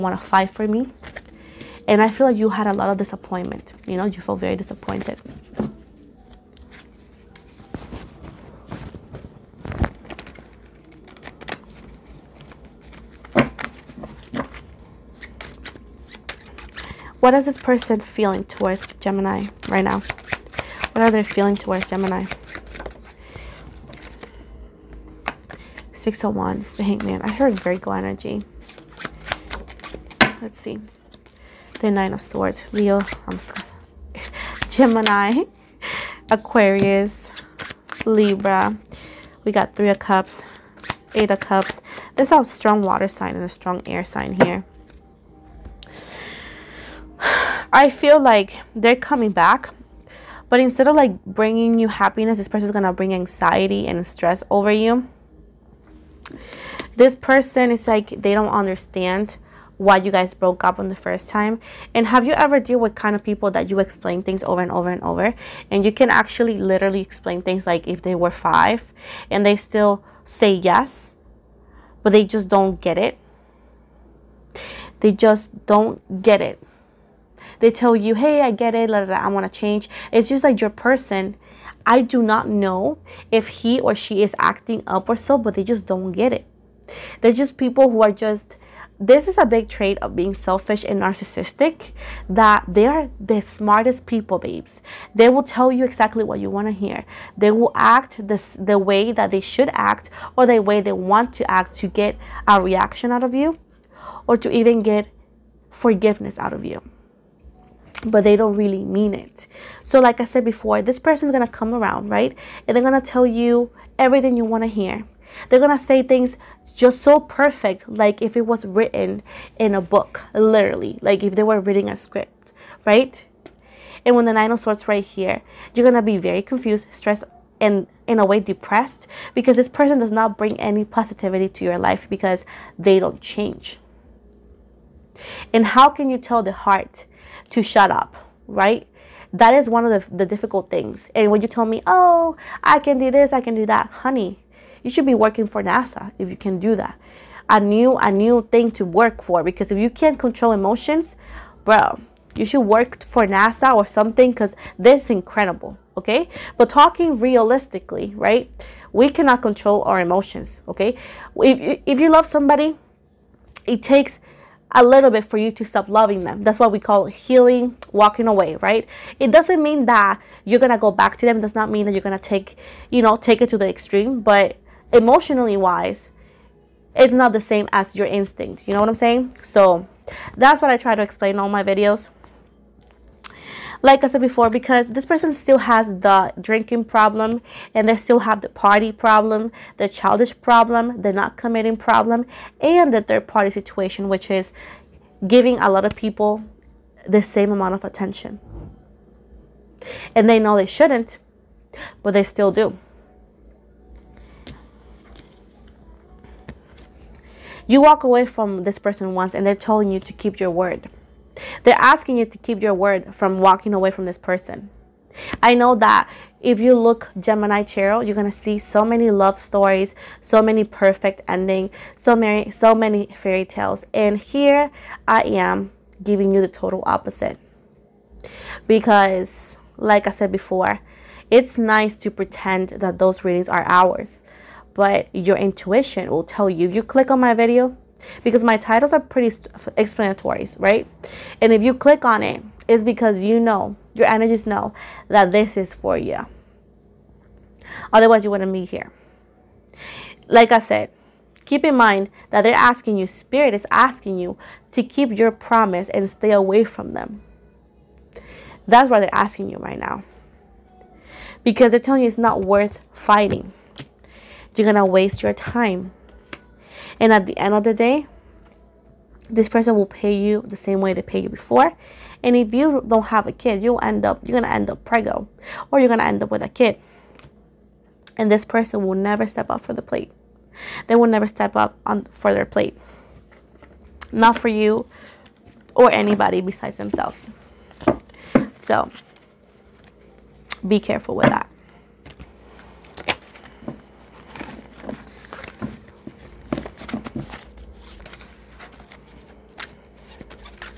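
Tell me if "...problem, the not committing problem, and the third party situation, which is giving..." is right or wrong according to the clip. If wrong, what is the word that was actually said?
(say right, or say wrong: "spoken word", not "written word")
right.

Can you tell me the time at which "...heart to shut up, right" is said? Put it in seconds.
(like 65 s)
136 s.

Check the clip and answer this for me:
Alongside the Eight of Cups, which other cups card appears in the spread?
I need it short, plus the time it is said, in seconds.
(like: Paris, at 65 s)
Three of Cups, at 39 s.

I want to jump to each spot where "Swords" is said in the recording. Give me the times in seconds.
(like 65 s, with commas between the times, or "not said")
32 s, 124 s.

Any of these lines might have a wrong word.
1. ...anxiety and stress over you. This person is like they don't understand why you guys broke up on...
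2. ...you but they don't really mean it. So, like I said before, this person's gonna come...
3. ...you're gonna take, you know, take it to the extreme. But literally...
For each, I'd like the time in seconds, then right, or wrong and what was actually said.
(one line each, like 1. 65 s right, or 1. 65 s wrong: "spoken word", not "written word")
1. 53 s right
2. 106 s right
3. 171 s wrong: "emotionally", not "literally".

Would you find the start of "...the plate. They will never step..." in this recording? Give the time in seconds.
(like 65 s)
279 s.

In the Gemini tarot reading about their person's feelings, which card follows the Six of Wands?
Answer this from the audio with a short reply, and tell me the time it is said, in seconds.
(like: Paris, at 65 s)
The Hangman, at 26 s.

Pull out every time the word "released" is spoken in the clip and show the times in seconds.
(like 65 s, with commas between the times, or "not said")
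not said.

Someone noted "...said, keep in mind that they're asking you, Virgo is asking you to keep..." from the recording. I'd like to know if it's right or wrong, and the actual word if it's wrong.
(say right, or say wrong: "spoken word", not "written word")
wrong: "Spirit", not "Virgo".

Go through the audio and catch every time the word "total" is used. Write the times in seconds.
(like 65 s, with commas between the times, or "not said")
226 s.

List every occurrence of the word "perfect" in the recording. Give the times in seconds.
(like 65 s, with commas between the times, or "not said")
117 s, 220 s.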